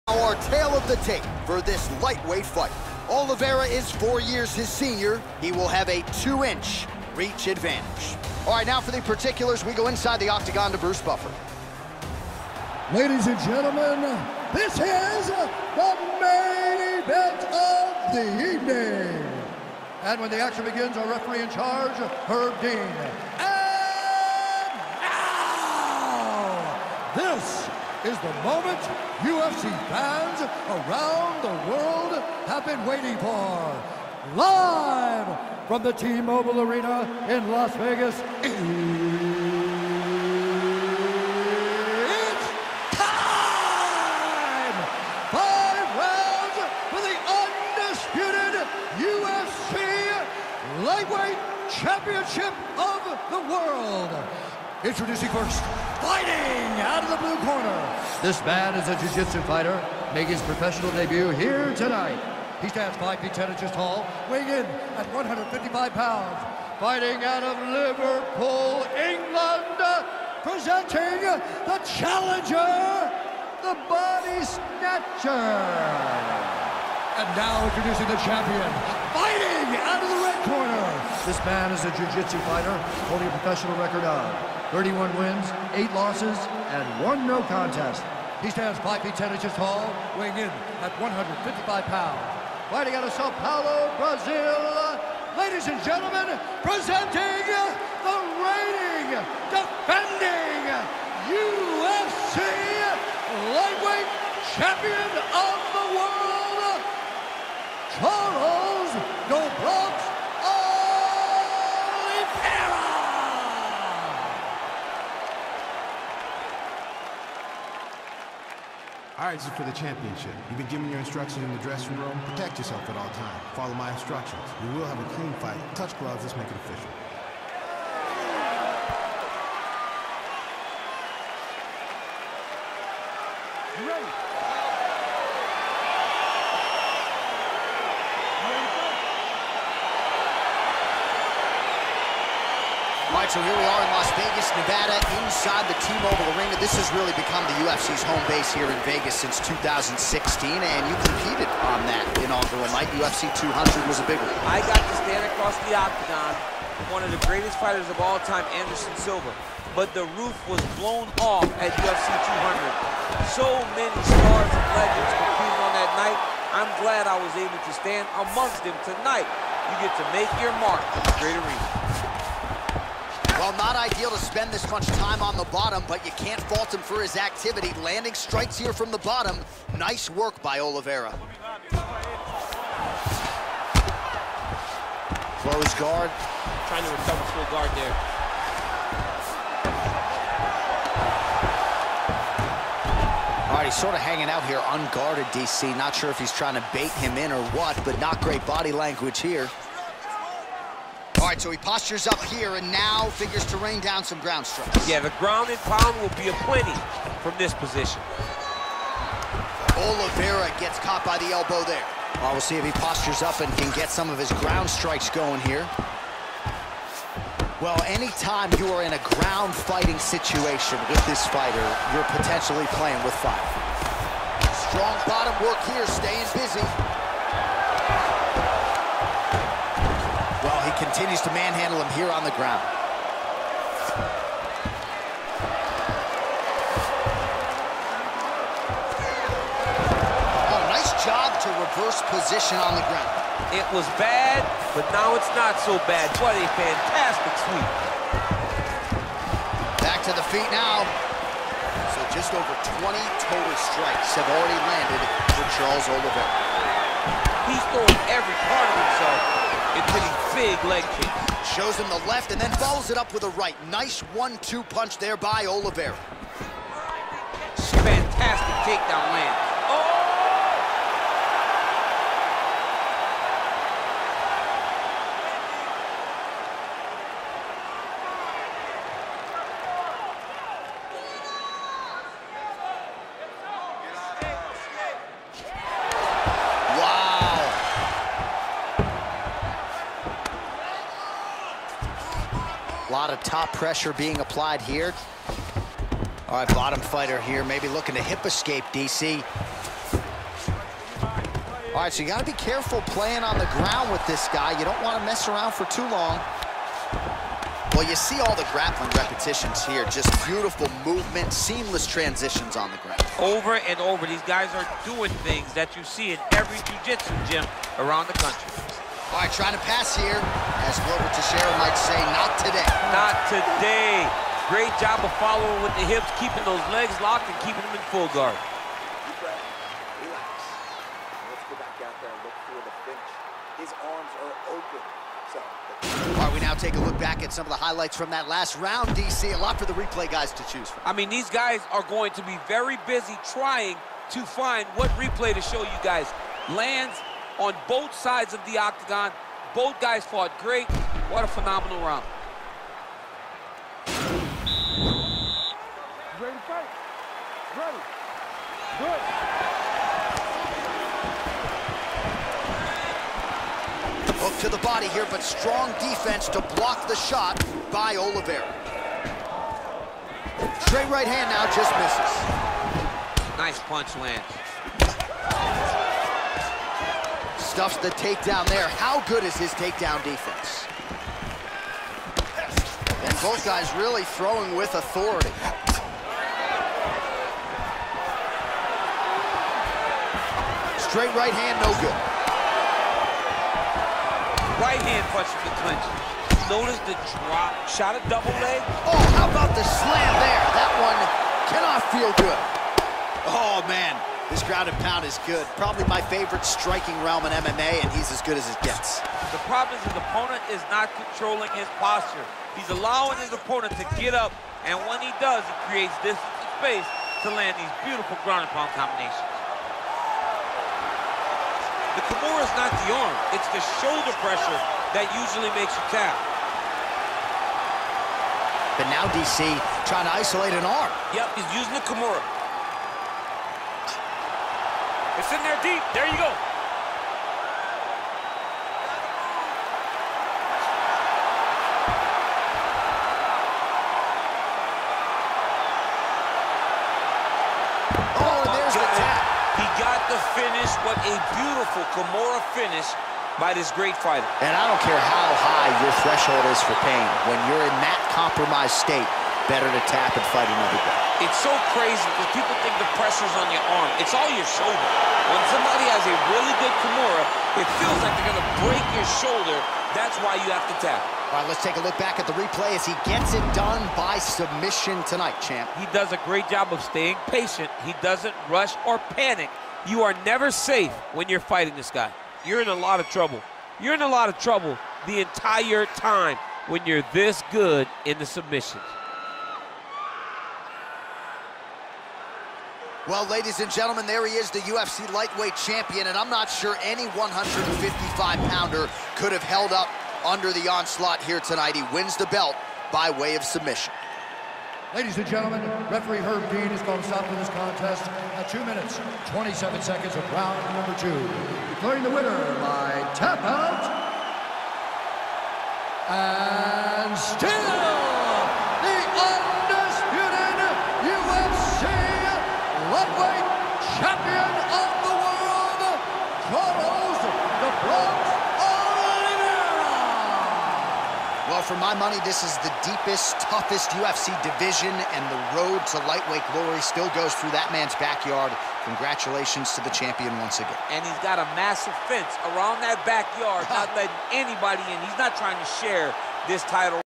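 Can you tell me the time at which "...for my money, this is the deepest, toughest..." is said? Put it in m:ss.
8:51.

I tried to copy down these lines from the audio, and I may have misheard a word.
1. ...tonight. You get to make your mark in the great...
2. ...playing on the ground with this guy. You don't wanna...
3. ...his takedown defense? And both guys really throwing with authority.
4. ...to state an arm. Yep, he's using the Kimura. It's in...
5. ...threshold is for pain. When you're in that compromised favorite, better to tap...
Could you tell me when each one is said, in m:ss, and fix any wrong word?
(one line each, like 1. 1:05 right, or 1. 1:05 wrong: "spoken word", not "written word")
1. 2:48 right
2. 5:02 right
3. 6:19 right
4. 7:10 wrong: "isolate", not "state"
5. 7:36 wrong: "state", not "favorite".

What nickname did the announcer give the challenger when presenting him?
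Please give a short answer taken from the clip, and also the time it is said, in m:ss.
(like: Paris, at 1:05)
the body snatcher, at 1:13.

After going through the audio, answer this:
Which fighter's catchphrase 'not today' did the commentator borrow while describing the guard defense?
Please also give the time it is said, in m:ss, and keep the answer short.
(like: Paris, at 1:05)
Glover Teixeira, at 5:20.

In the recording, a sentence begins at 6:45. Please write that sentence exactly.
Probably my favorite striking realm in MMA, and he's as good as it gets.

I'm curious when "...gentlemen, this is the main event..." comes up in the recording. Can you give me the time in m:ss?
0:13.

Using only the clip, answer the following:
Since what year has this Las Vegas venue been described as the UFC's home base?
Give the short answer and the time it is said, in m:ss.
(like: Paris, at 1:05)
2016, at 2:29.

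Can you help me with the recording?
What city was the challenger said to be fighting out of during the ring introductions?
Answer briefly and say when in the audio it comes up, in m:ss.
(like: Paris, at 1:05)
Liverpool, England, at 1:07.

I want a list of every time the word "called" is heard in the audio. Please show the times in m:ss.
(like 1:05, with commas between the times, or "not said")
8:26.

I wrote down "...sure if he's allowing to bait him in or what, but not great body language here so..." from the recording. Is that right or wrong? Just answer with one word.
wrong.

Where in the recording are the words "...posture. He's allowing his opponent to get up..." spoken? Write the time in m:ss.
6:51.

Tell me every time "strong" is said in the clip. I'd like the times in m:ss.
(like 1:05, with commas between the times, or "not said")
3:44, 6:05.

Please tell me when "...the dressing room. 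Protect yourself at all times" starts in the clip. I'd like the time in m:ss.
2:01.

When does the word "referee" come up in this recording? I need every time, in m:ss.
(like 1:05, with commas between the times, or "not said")
0:21, 8:25.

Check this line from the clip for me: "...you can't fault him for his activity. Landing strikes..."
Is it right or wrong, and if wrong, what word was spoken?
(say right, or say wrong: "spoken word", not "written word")
right.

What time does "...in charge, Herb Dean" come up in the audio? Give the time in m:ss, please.
0:21.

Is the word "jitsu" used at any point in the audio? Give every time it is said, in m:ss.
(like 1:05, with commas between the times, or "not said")
0:58, 1:21, 5:16.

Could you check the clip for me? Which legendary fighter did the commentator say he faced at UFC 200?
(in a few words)
Anderson Silva.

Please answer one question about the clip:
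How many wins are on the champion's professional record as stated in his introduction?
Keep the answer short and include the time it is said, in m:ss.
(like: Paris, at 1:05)
31, at 1:24.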